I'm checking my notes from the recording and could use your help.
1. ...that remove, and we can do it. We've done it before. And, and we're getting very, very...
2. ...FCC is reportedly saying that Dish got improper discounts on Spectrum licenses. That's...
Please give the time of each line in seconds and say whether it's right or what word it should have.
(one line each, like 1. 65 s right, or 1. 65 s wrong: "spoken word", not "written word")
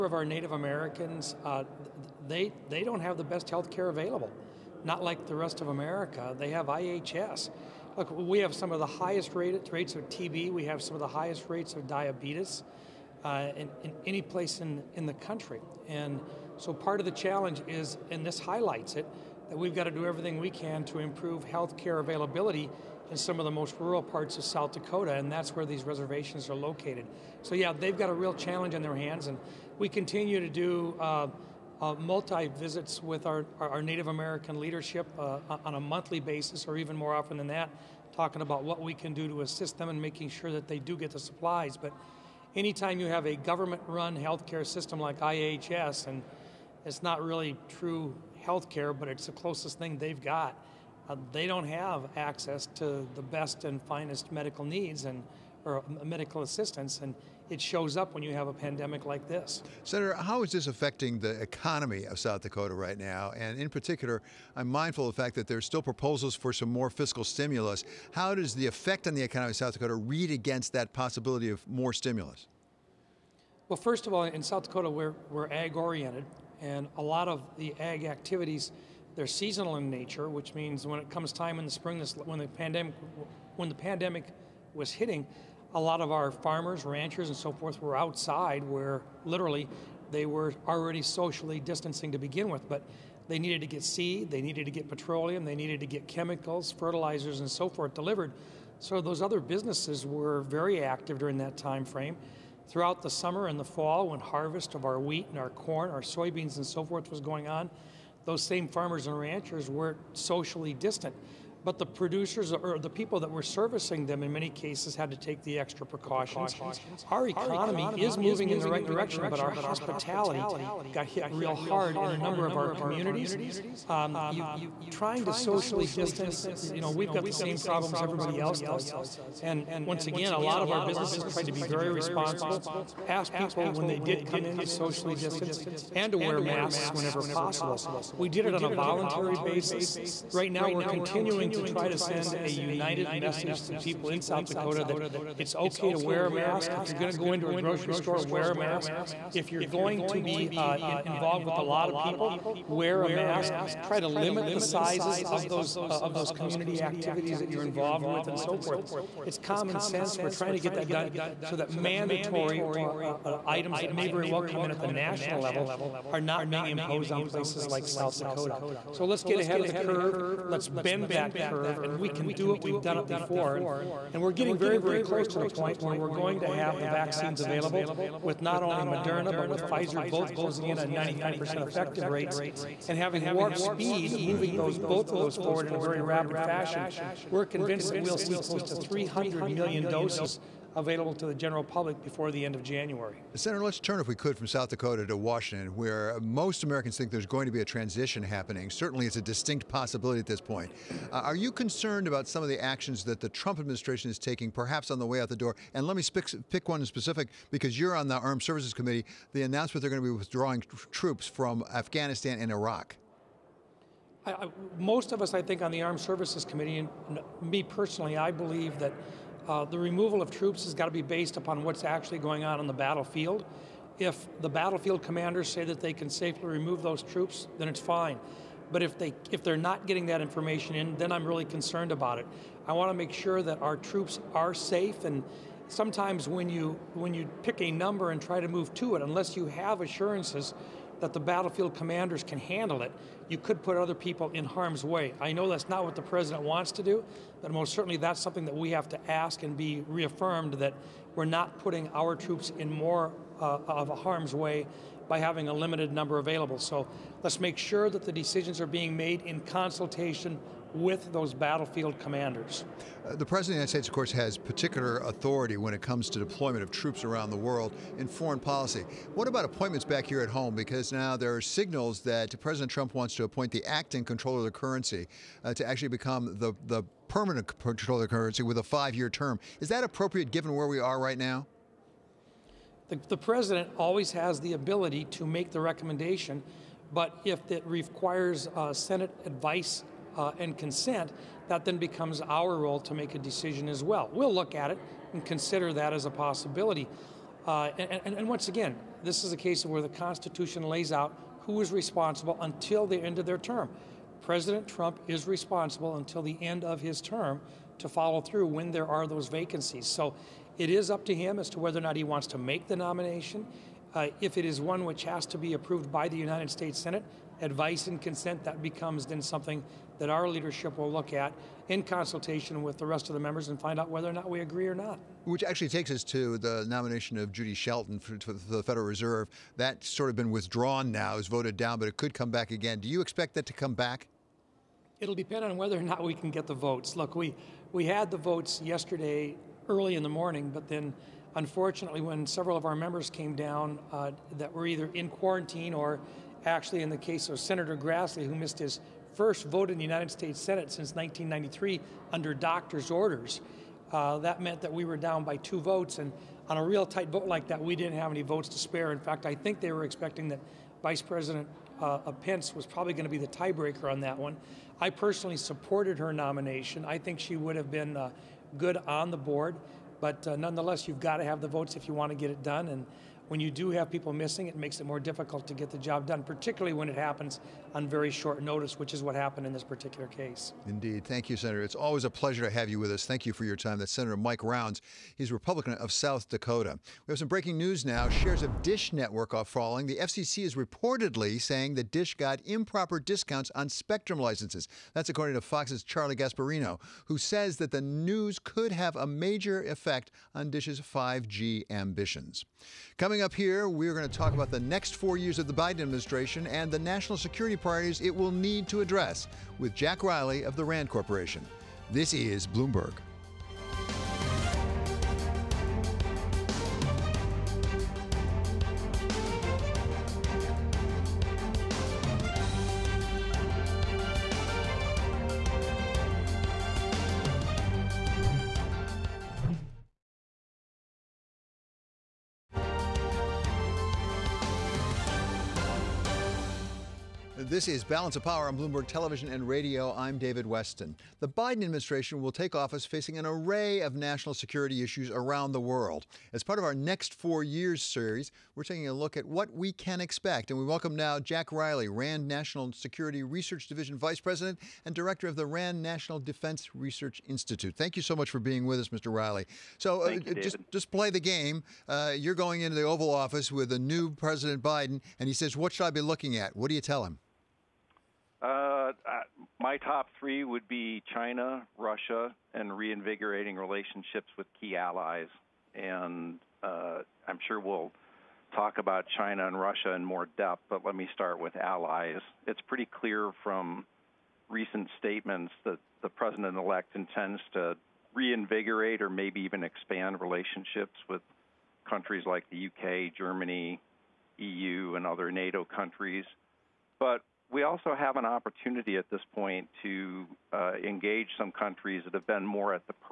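1. 171 s wrong: "curve", not "remove"
2. 389 s right.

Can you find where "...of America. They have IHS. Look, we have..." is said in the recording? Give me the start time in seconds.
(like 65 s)
5 s.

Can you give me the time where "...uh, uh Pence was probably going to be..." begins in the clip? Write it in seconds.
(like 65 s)
361 s.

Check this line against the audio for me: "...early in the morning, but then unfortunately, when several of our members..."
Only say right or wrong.
right.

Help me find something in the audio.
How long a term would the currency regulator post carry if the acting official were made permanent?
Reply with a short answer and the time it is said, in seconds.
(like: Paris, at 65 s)
5 years, at 278 s.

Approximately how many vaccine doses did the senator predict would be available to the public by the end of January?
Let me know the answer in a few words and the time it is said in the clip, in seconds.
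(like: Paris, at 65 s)
300 million, at 188 s.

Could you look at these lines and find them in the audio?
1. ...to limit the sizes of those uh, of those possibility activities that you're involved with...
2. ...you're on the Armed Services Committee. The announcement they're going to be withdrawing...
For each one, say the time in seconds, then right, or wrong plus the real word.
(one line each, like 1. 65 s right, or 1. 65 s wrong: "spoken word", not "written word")
1. 154 s wrong: "community", not "possibility"
2. 207 s right.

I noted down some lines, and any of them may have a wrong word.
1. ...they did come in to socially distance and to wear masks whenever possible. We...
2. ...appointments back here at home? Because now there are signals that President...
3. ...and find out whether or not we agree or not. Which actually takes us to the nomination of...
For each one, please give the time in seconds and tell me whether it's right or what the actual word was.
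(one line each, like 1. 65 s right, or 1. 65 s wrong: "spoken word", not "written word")
1. 133 s right
2. 269 s right
3. 323 s right.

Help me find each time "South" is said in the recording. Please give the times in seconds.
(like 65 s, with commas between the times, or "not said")
24 s, 62 s, 69 s, 74 s, 144 s, 167 s, 194 s, 385 s.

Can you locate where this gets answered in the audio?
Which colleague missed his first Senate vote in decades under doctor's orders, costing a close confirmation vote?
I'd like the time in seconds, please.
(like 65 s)
347 s.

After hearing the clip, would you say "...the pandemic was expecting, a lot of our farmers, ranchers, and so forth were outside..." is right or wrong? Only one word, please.
wrong.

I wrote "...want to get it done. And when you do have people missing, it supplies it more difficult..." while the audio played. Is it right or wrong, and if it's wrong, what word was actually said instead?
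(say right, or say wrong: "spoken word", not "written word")
wrong: "makes", not "supplies".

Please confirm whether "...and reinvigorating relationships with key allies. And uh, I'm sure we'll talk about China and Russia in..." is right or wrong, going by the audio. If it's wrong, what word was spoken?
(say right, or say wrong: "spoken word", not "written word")
right.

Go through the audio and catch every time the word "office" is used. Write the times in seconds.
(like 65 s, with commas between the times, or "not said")
442 s, 463 s.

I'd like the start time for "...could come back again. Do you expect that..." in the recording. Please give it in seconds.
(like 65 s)
331 s.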